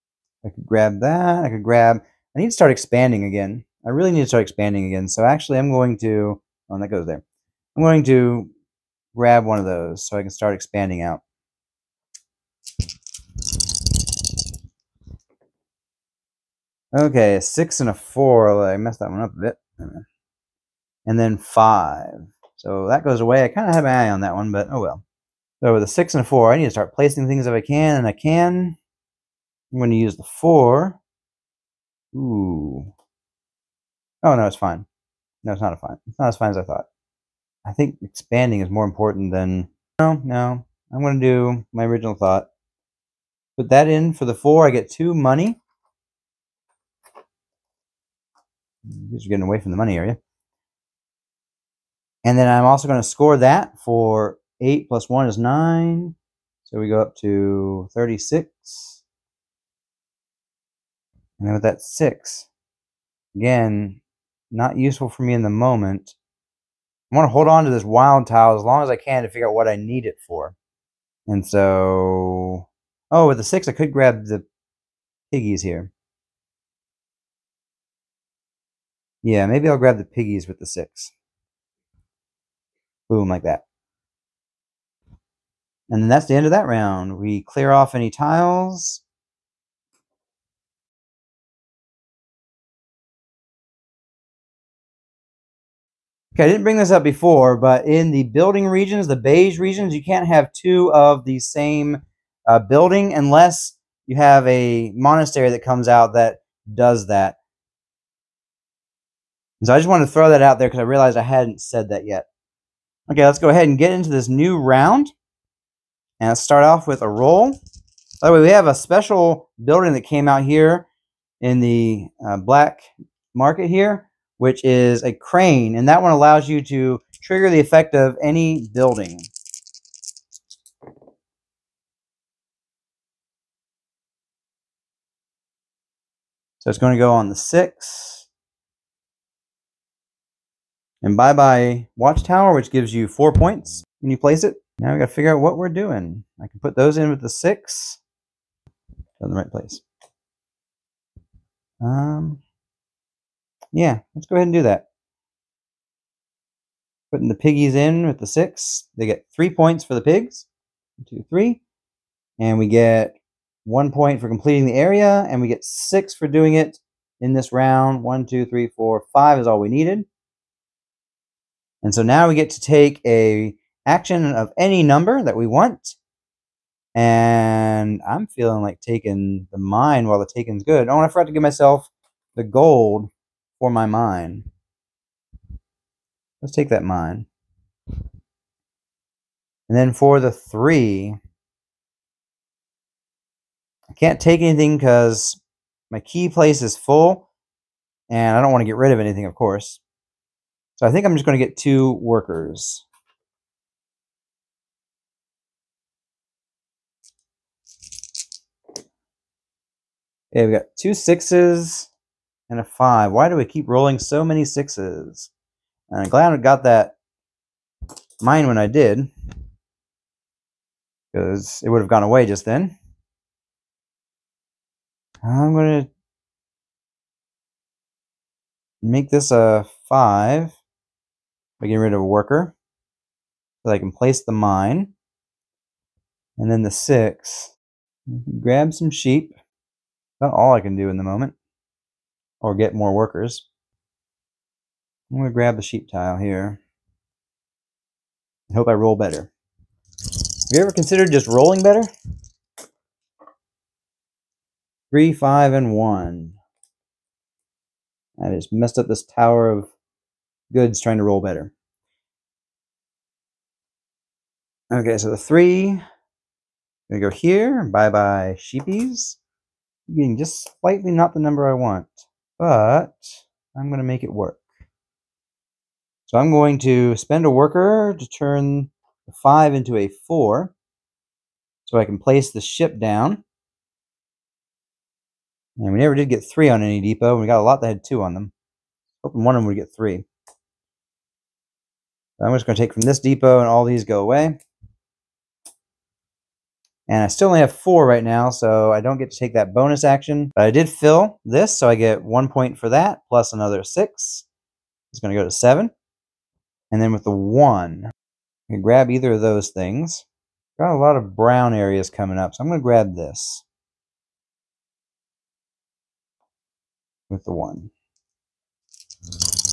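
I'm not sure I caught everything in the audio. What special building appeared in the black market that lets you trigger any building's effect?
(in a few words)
crane.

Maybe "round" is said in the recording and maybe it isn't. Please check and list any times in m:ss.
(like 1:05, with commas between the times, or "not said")
1:26, 1:54, 2:47.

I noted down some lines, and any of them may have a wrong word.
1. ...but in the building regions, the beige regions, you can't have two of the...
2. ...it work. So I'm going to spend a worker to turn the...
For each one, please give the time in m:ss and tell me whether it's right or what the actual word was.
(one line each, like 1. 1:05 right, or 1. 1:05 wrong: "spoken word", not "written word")
1. 1:37 right
2. 4:34 right.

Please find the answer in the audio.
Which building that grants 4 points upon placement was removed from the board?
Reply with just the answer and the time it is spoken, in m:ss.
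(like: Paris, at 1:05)
Watchtower, at 2:21.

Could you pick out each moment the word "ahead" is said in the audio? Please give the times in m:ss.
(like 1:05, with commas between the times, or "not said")
1:53, 2:34.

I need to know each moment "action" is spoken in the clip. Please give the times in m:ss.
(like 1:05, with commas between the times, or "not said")
2:53, 4:59.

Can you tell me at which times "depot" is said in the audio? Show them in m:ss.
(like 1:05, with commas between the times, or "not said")
4:46, 4:52.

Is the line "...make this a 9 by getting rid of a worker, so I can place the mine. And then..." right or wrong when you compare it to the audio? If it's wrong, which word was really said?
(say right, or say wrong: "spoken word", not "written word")
wrong: "5", not "9".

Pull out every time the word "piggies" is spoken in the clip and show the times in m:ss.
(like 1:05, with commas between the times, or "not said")
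1:15, 1:20, 2:37.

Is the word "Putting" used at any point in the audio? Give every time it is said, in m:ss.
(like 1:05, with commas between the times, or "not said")
2:37.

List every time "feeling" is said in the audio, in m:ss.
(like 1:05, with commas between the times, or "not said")
2:58.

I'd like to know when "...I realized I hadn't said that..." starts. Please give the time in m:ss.
1:50.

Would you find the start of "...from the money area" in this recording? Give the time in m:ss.
0:49.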